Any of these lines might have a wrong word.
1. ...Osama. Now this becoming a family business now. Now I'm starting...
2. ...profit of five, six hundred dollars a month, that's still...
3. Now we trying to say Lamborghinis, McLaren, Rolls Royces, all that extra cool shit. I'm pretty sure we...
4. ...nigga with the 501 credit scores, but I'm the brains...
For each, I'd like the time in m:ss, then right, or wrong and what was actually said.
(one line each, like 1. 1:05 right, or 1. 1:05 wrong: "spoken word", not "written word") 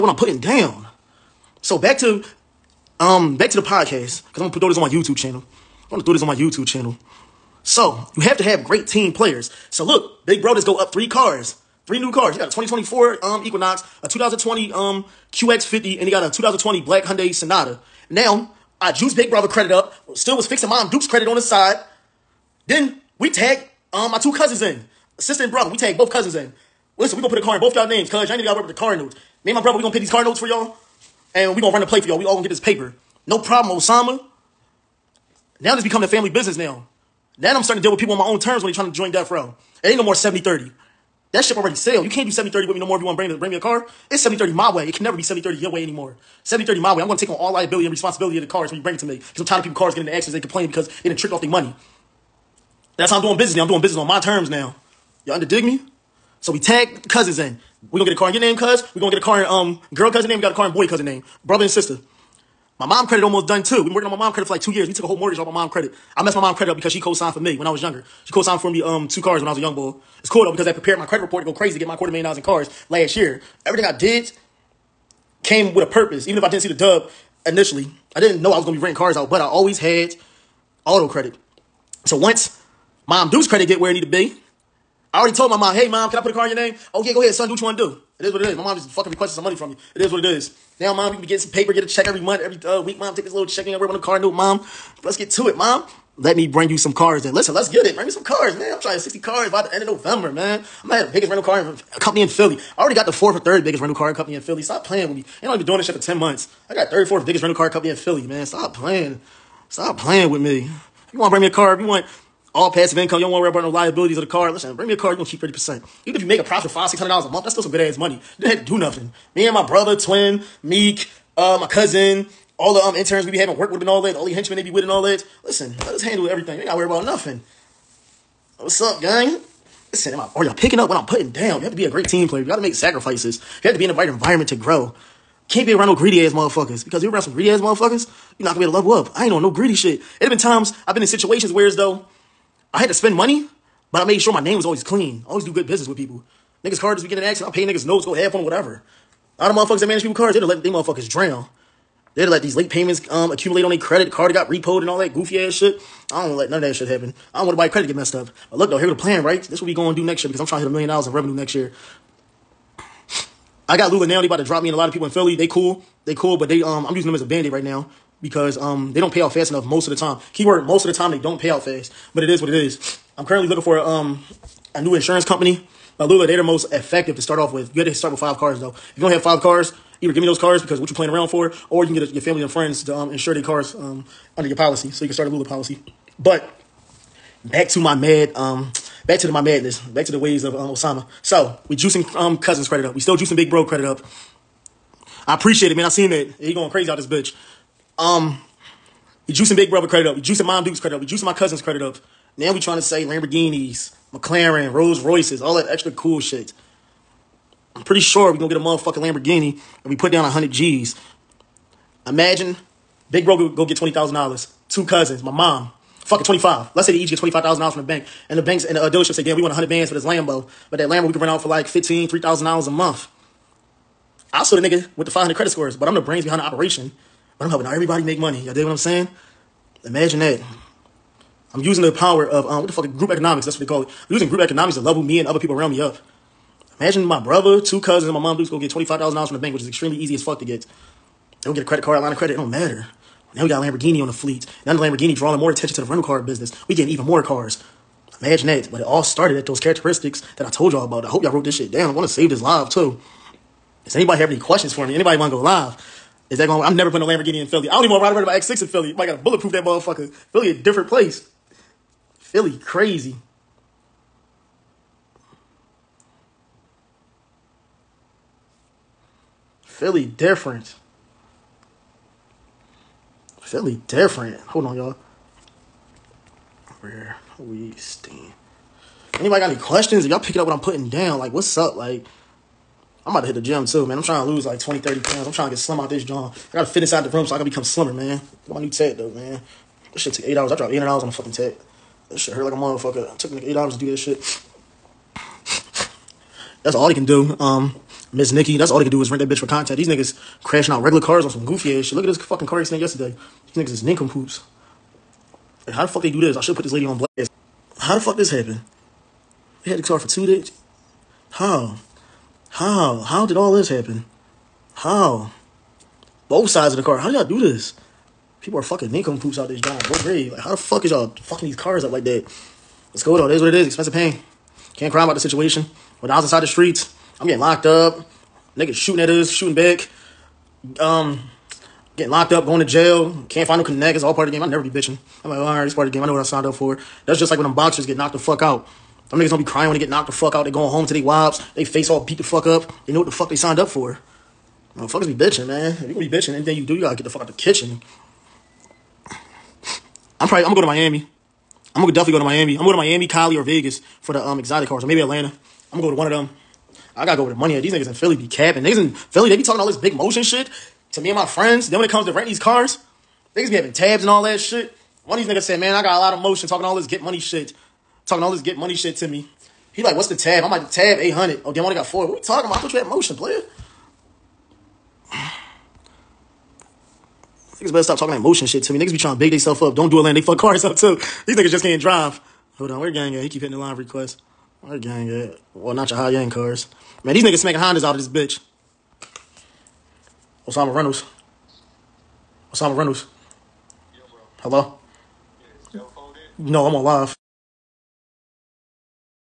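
1. 0:33 right
2. 1:56 right
3. 3:22 right
4. 3:44 wrong: "500", not "501".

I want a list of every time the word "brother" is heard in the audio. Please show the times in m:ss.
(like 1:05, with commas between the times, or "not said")
0:19, 0:25, 0:29, 1:01, 1:59, 3:19, 3:57.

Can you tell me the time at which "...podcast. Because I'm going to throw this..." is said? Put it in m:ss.
0:03.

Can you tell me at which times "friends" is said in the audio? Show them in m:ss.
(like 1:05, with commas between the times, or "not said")
3:02, 6:01.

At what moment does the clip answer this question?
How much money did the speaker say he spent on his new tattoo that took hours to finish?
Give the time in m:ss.
4:50.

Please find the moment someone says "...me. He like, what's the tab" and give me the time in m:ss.
6:09.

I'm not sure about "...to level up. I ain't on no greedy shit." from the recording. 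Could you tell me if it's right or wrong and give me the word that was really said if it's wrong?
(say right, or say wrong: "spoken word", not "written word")
right.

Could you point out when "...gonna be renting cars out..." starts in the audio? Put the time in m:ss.
1:18.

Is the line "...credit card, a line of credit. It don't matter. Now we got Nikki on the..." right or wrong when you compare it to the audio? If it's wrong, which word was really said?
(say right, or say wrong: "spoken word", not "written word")
wrong: "Lamborghini", not "Nikki".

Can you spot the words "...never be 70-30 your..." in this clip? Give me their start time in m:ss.
0:45.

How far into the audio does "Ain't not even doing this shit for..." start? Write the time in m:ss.
1:45.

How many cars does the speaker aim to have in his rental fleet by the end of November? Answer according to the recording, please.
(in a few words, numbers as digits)
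60.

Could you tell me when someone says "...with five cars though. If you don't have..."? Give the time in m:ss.
2:58.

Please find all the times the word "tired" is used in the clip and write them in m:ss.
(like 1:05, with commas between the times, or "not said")
0:49.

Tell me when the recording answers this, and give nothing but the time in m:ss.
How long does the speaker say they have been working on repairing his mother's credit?
1:04.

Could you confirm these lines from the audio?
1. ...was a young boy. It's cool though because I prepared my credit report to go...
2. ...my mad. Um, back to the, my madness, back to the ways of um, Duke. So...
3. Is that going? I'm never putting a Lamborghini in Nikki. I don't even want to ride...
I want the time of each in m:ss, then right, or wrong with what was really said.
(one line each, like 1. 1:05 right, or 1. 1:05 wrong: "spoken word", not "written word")
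1. 1:09 right
2. 3:07 wrong: "Osama", not "Duke"
3. 4:16 wrong: "Philly", not "Nikki".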